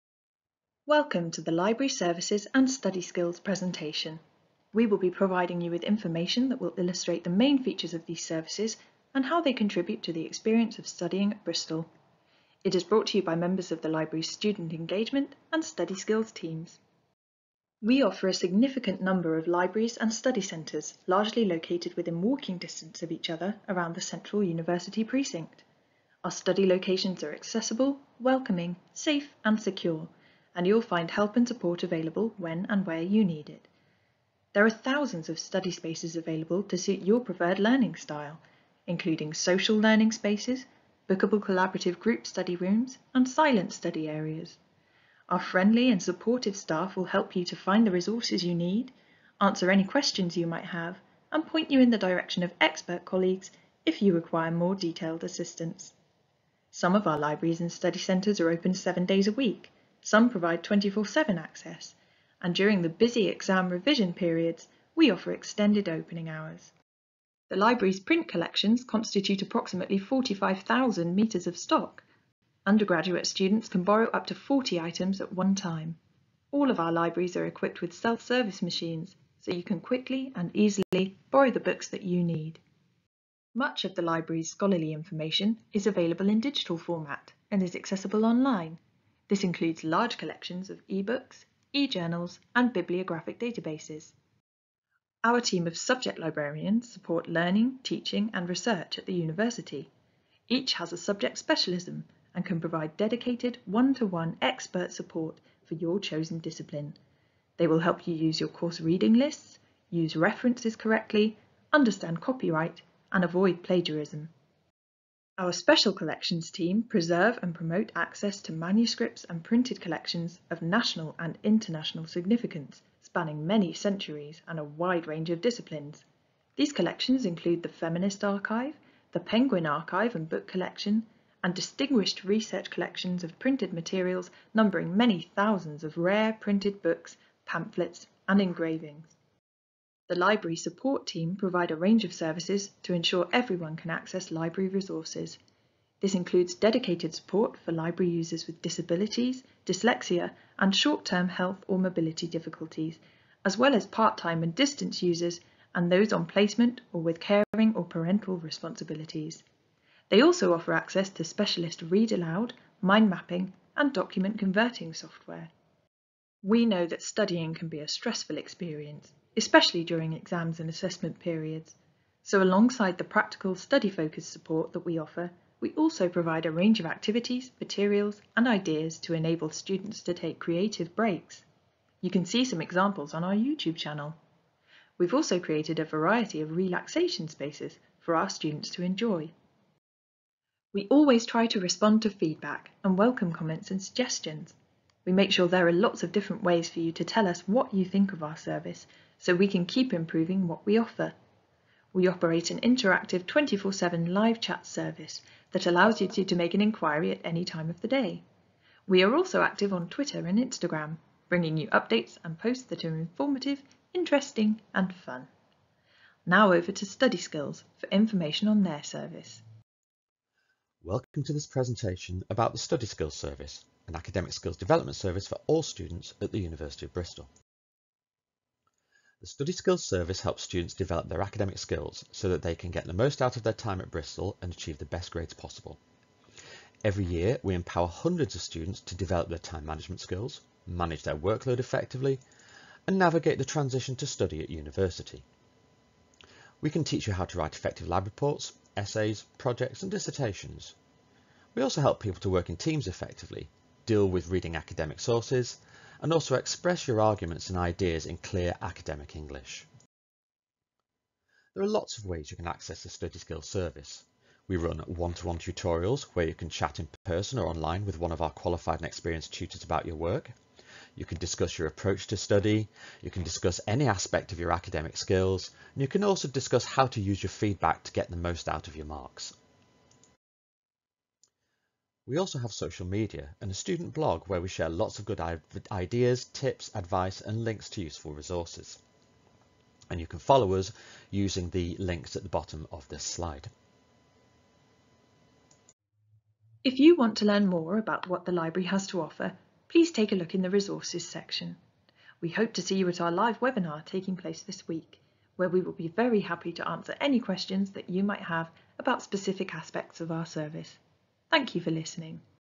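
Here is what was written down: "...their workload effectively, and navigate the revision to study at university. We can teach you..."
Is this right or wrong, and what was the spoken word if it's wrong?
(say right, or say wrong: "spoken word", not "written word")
wrong: "transition", not "revision".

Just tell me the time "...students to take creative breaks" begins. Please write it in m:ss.
2:59.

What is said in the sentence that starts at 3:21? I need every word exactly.
We operate an interactive 24-7 live chat service that allows you to, to make an inquiry at any time of the day.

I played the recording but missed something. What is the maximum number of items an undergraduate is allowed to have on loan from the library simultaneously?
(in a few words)
40.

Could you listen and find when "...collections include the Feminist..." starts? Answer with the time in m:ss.
2:06.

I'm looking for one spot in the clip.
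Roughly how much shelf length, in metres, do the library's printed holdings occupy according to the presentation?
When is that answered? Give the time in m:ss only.
1:09.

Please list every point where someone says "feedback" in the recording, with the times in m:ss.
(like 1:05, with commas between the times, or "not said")
3:12, 4:37.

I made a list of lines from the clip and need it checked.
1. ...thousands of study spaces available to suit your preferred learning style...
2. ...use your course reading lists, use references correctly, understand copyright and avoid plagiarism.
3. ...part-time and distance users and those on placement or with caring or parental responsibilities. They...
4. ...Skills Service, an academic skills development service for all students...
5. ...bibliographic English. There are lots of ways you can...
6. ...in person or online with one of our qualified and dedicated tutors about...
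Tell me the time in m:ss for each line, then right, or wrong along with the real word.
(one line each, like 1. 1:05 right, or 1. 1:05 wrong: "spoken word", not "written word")
1. 0:34 right
2. 1:48 right
3. 2:33 right
4. 3:42 right
5. 4:18 wrong: "academic", not "bibliographic"
6. 4:26 wrong: "experienced", not "dedicated".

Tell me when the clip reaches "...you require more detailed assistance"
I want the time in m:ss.
0:54.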